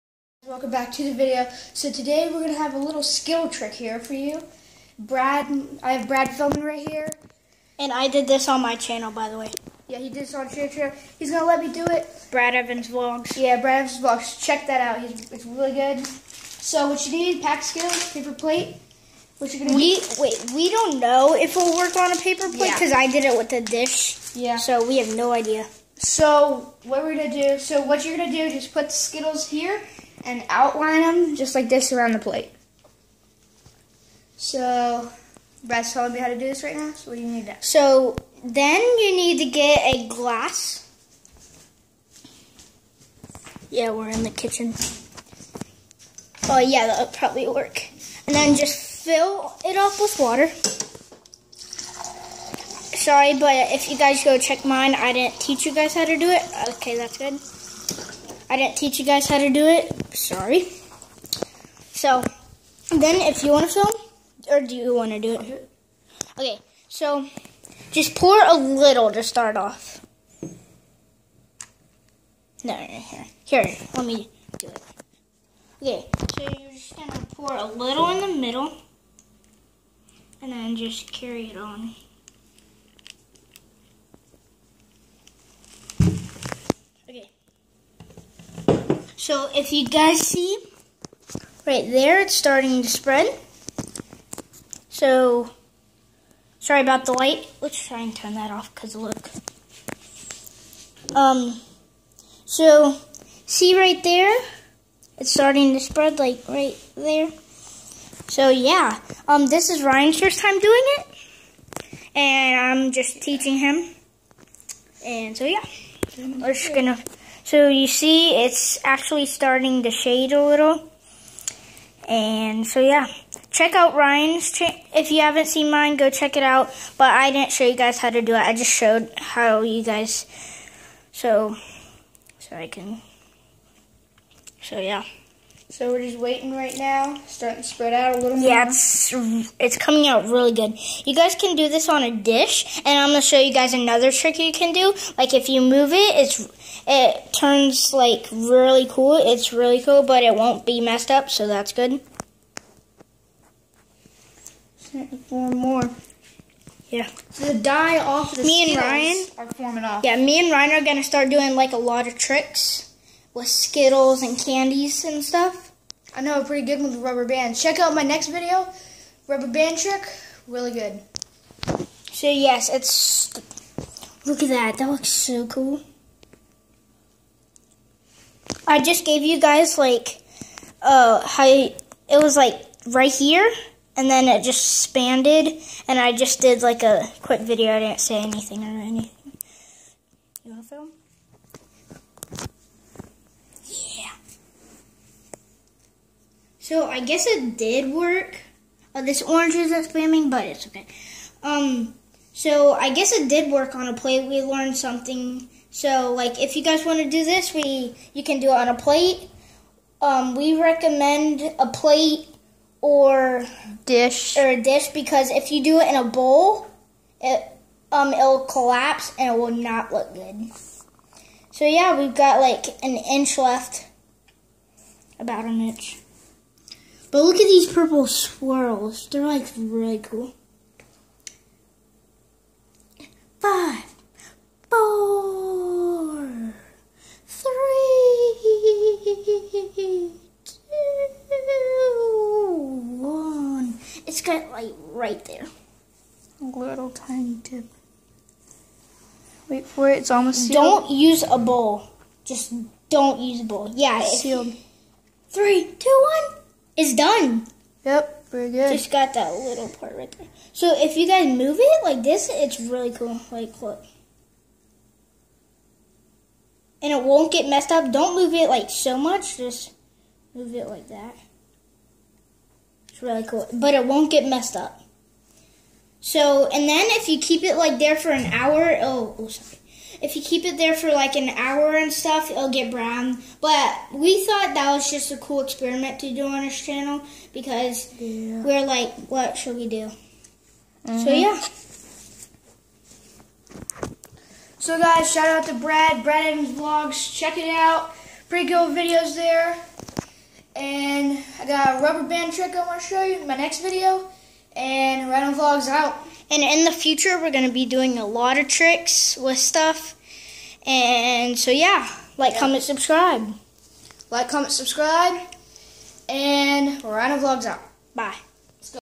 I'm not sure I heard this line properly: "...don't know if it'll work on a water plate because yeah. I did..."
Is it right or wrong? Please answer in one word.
wrong.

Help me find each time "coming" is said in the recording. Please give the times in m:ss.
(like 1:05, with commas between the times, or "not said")
2:19.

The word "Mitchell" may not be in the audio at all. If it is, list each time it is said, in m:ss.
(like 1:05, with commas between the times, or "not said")
not said.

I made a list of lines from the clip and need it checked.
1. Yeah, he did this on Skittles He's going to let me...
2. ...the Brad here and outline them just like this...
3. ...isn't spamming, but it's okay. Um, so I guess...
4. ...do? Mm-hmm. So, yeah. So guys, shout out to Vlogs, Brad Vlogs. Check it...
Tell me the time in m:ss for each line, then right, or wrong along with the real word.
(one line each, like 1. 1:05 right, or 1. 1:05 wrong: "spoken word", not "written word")
1. 0:09 wrong: "Share", not "Skittles"
2. 0:28 wrong: "Skittles", not "Brad"
3. 3:19 right
4. 4:49 wrong: "Brad", not "Vlogs".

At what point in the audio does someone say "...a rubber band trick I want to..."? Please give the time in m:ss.
5:01.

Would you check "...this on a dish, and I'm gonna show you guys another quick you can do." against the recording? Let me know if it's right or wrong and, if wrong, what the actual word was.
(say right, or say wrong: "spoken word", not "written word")
wrong: "trick", not "quick".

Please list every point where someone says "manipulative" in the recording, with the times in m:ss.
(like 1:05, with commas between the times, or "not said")
not said.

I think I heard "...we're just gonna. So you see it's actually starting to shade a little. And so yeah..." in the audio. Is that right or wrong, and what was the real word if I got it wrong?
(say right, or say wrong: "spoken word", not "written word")
right.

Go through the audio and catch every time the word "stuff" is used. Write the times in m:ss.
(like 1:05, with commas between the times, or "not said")
2:45, 4:41, 5:09.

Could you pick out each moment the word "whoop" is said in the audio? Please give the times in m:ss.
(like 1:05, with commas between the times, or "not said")
not said.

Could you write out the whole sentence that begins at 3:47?
But look at these purple swirls; they're like really cool.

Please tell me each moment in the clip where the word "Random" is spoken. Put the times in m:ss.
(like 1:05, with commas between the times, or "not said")
5:05, 5:16.